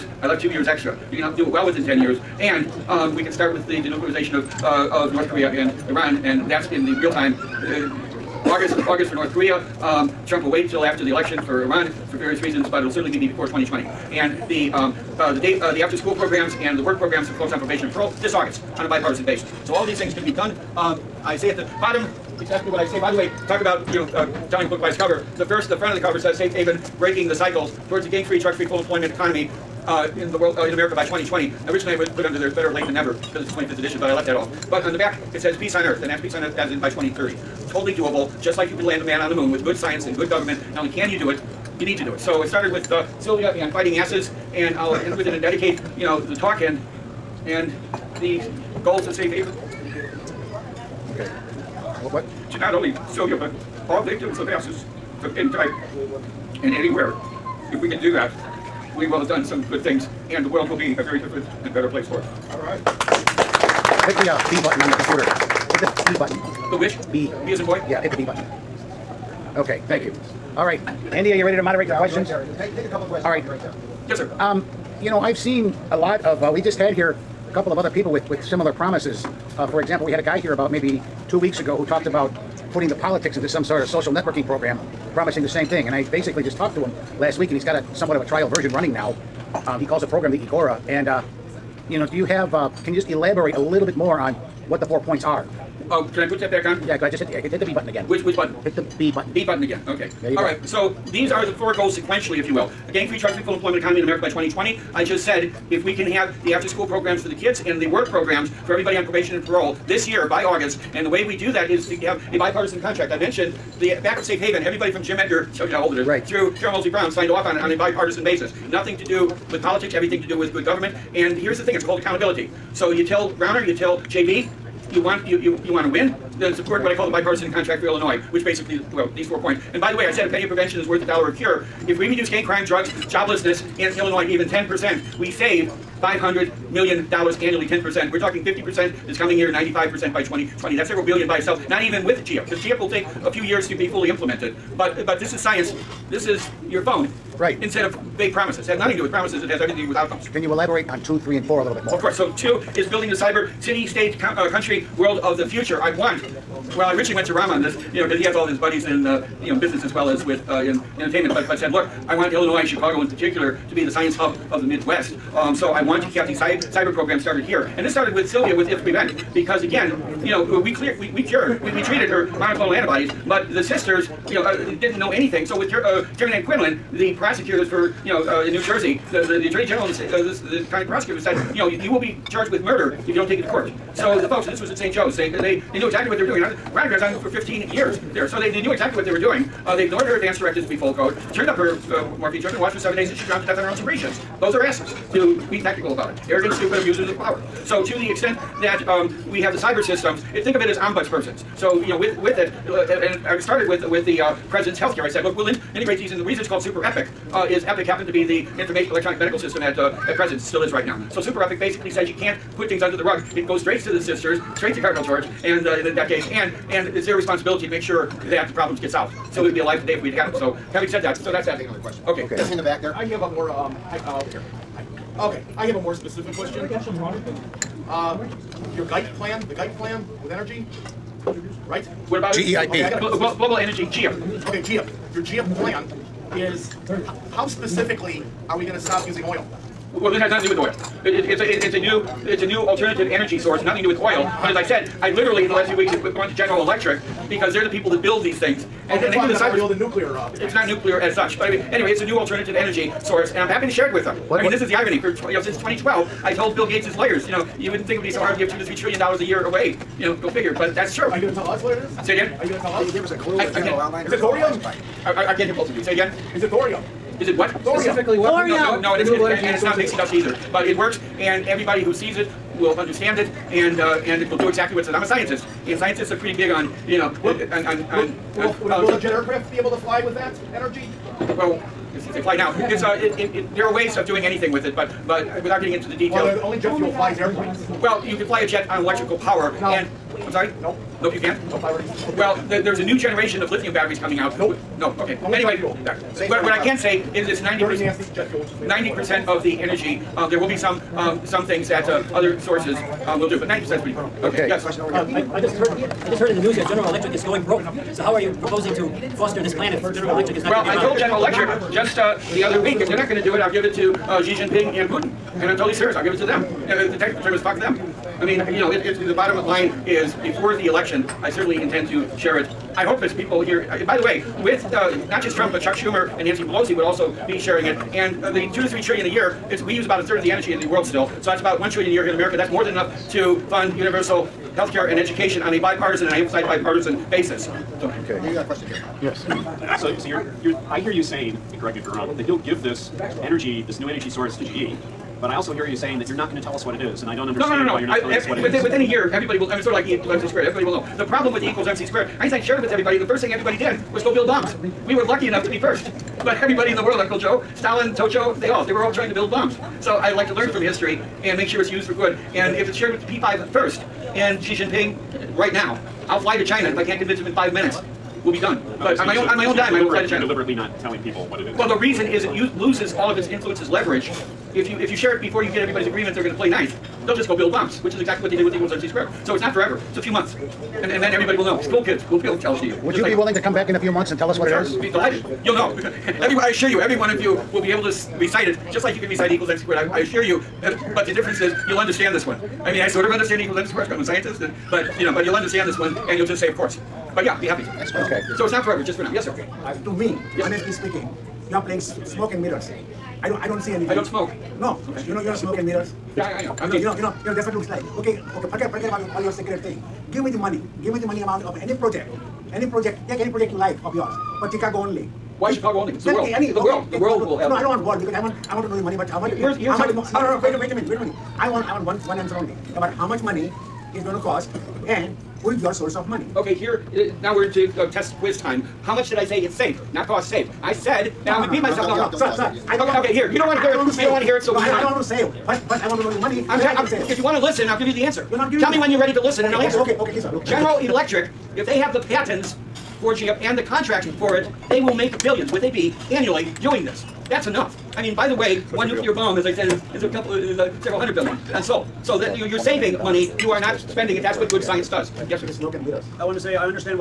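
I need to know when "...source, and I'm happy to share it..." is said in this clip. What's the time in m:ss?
4:13.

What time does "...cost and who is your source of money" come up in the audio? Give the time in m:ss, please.
7:04.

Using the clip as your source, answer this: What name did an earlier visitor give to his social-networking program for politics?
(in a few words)
Igora.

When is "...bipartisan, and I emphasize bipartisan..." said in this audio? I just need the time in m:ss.
5:35.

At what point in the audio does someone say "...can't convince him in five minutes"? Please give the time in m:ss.
6:06.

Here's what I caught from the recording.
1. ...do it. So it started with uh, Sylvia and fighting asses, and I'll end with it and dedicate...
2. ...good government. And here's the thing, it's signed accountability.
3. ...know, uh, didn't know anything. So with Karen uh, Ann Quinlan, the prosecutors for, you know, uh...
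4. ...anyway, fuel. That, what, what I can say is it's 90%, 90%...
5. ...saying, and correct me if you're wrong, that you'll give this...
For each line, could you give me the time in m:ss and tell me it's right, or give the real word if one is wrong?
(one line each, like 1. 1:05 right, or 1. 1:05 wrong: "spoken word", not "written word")
1. 0:42 right
2. 2:00 wrong: "called", not "signed"
3. 2:54 right
4. 4:55 right
5. 5:41 right.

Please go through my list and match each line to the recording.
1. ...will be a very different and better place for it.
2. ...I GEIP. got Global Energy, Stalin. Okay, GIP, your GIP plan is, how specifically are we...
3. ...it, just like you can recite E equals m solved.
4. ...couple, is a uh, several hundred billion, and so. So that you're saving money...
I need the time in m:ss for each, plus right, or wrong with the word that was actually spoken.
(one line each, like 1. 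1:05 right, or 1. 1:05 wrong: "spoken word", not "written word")
1. 1:00 right
2. 3:52 wrong: "GIA", not "Stalin"
3. 6:28 wrong: "squared", not "solved"
4. 7:30 right.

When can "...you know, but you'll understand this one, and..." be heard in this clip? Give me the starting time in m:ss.
6:35.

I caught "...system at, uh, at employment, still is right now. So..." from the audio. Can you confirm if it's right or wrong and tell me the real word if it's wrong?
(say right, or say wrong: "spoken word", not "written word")
wrong: "present", not "employment".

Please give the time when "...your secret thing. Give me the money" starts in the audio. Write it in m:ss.
6:49.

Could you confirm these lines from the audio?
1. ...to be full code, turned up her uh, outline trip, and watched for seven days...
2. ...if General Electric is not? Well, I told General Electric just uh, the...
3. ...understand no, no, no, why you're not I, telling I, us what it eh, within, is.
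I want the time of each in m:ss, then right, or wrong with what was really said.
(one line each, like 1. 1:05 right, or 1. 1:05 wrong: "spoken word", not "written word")
1. 3:10 wrong: "morphine", not "outline"
2. 5:09 right
3. 5:47 right.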